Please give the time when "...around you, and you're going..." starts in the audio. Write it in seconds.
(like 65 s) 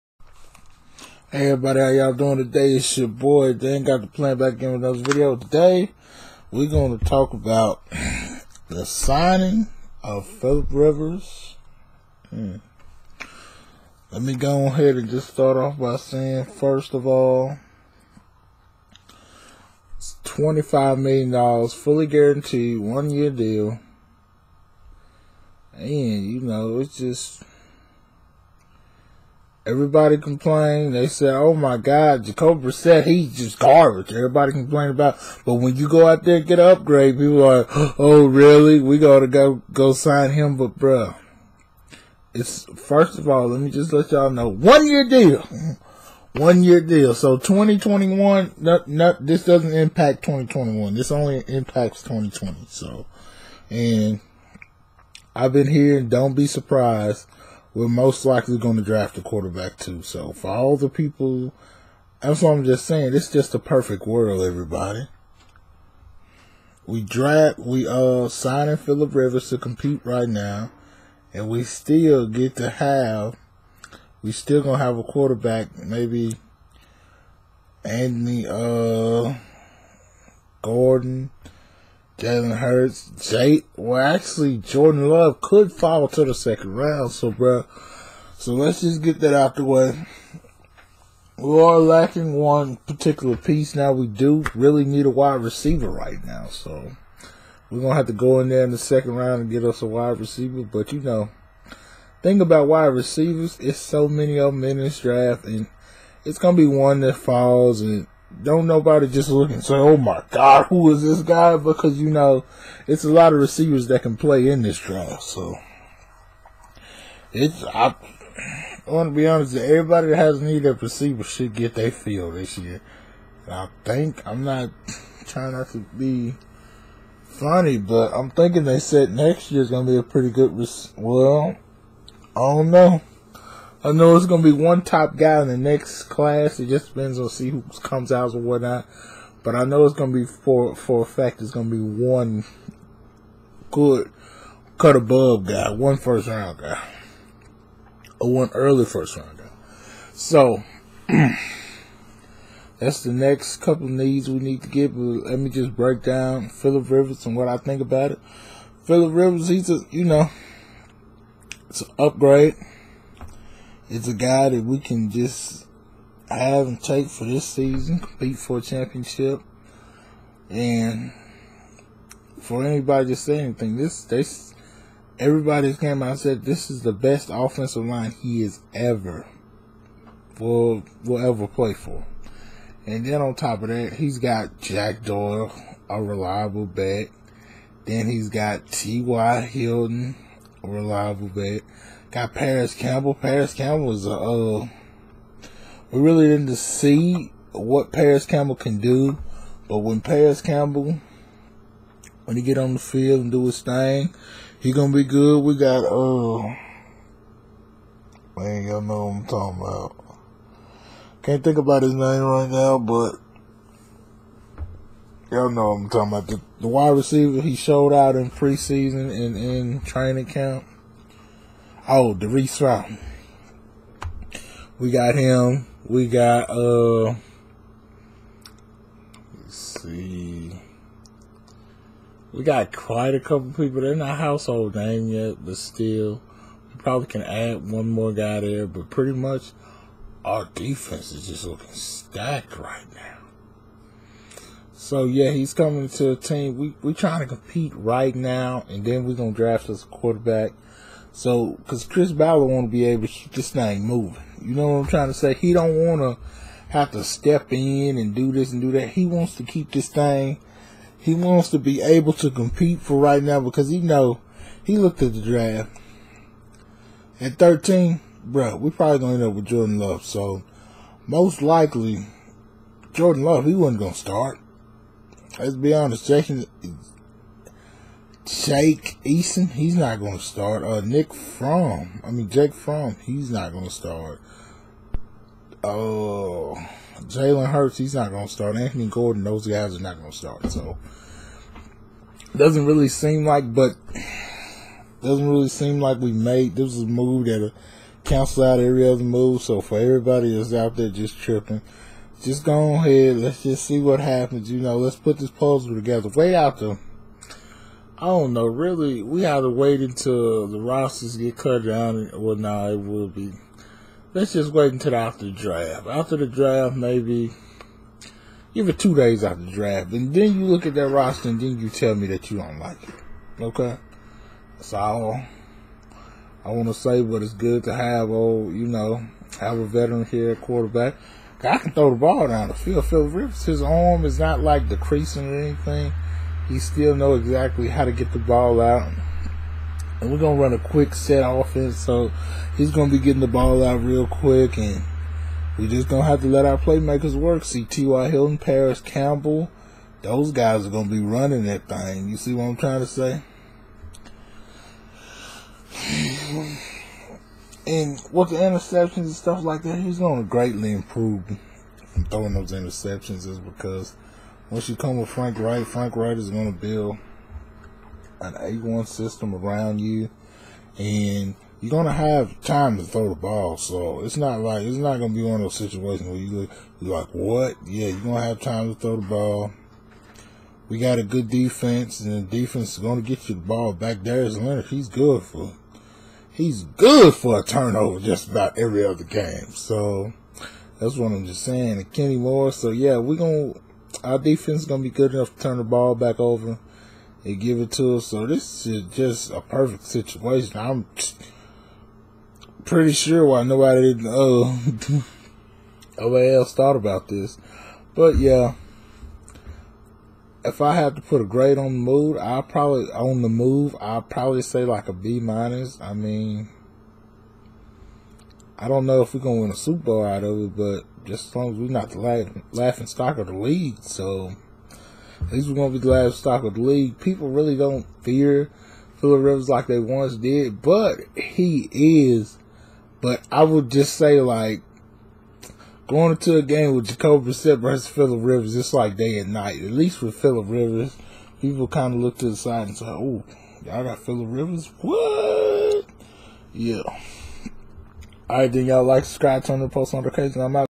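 369 s.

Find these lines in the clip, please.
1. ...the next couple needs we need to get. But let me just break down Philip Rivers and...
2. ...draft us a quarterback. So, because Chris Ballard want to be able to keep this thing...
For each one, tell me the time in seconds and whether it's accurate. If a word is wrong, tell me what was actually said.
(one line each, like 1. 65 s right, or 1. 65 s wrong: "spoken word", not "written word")
1. 153 s right
2. 249 s right.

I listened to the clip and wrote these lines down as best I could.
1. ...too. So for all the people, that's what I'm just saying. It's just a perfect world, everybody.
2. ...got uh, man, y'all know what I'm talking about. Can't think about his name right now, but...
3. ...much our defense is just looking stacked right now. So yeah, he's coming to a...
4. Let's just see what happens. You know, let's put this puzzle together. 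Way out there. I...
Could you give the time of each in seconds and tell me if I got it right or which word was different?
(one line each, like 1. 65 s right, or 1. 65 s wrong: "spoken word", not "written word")
1. 59 s right
2. 205 s right
3. 239 s right
4. 303 s right.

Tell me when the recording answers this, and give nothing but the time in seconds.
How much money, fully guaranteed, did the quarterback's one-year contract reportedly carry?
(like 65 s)
20 s.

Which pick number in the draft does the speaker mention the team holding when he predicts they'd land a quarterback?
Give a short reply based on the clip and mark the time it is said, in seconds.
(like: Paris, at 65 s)
13, at 267 s.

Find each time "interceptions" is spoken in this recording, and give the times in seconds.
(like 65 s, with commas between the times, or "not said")
358 s, 362 s.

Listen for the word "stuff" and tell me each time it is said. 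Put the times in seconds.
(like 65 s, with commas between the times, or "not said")
359 s.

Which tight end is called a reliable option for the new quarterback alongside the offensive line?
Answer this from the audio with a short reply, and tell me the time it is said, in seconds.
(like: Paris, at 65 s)
Jack Doyle, at 184 s.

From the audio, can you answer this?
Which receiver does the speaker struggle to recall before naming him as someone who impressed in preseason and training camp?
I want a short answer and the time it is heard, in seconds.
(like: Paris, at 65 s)
Derek Route, at 222 s.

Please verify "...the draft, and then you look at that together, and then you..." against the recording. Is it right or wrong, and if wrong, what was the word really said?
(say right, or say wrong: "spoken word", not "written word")
wrong: "roster", not "together".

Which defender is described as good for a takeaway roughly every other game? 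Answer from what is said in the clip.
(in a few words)
Darius Leonard.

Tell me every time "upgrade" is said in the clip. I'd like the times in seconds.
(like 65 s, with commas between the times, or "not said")
36 s, 161 s.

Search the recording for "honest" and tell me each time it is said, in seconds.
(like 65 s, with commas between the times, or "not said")
119 s, 275 s.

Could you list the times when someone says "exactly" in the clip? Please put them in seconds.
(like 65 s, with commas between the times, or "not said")
337 s.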